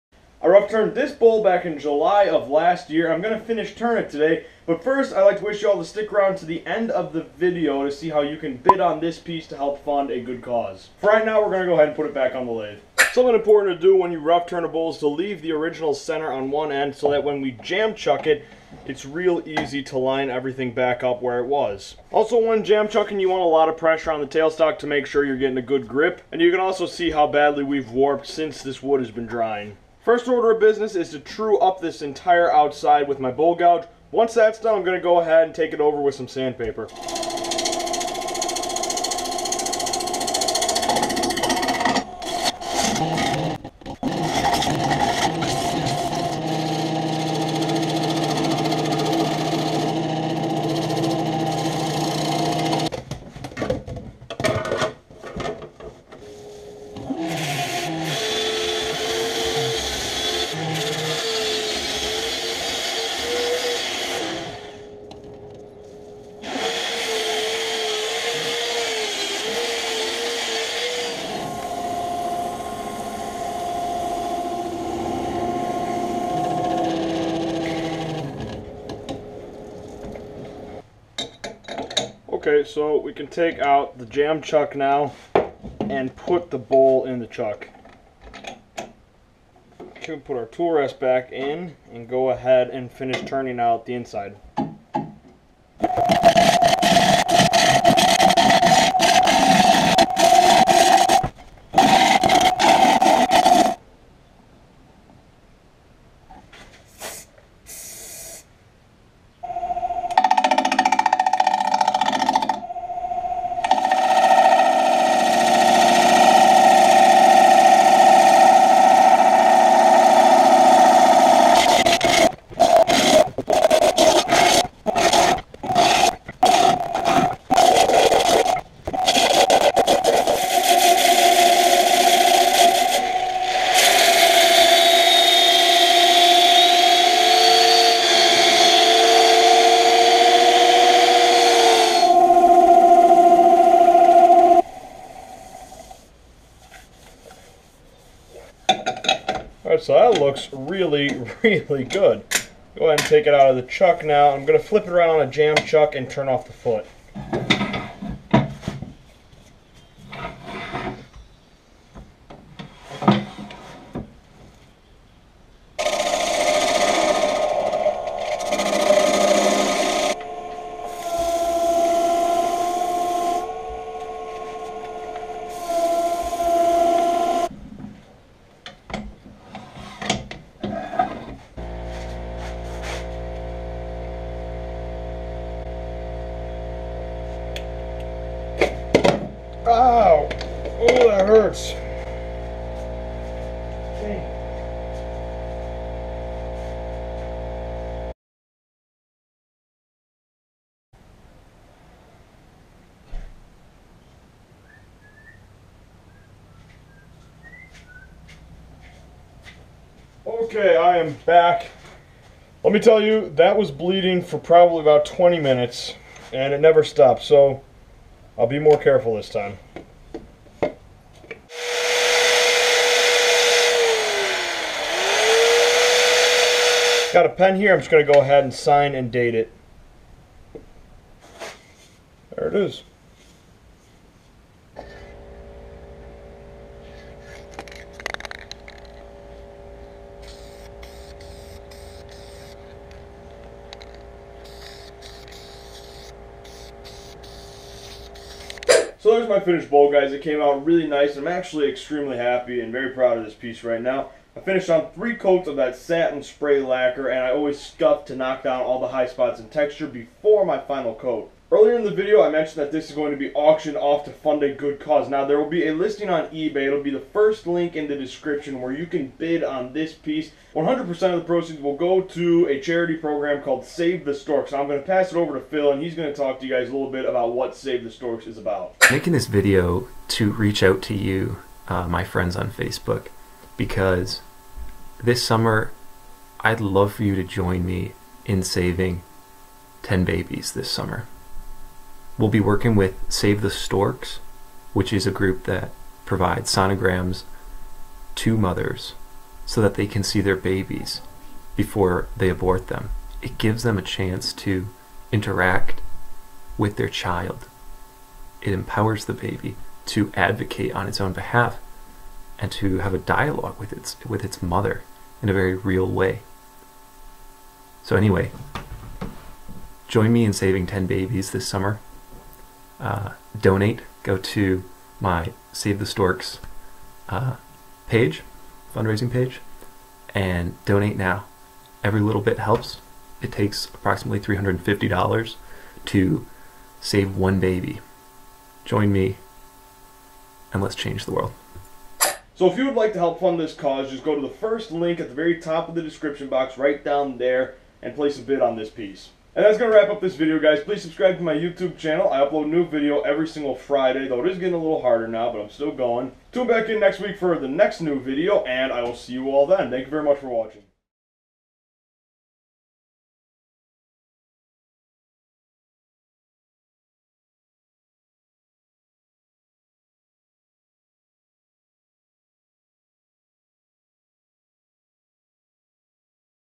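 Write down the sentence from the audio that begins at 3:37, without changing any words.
So I'll be more careful this time.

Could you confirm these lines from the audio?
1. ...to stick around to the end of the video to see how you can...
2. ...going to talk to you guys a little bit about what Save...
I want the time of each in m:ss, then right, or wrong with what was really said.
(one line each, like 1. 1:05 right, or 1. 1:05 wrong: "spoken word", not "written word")
1. 0:05 right
2. 4:35 right.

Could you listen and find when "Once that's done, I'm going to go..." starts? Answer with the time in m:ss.
0:34.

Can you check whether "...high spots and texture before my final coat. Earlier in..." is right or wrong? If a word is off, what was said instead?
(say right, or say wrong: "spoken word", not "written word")
right.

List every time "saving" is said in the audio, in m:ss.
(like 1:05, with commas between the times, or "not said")
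4:48, 5:20.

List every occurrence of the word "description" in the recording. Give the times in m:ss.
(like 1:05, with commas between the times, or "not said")
4:27, 5:45.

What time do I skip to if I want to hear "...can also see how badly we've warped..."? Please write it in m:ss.
0:26.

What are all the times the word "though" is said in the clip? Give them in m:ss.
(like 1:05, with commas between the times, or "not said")
5:54.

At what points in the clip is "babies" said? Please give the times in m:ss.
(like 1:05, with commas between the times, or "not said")
4:50, 5:00, 5:20.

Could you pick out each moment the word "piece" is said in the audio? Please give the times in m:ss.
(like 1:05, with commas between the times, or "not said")
0:09, 4:13, 4:29, 5:48.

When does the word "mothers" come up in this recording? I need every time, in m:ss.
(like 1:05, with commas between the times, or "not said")
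4:58, 5:14.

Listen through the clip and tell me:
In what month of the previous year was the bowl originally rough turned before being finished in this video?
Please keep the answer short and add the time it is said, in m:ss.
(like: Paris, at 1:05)
July, at 0:01.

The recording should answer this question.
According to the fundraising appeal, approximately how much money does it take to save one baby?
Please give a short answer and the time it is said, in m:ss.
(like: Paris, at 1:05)
$350, at 5:34.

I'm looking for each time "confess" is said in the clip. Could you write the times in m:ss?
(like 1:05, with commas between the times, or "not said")
not said.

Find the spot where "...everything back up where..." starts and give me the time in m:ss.
0:20.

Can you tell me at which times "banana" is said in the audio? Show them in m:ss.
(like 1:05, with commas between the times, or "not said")
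not said.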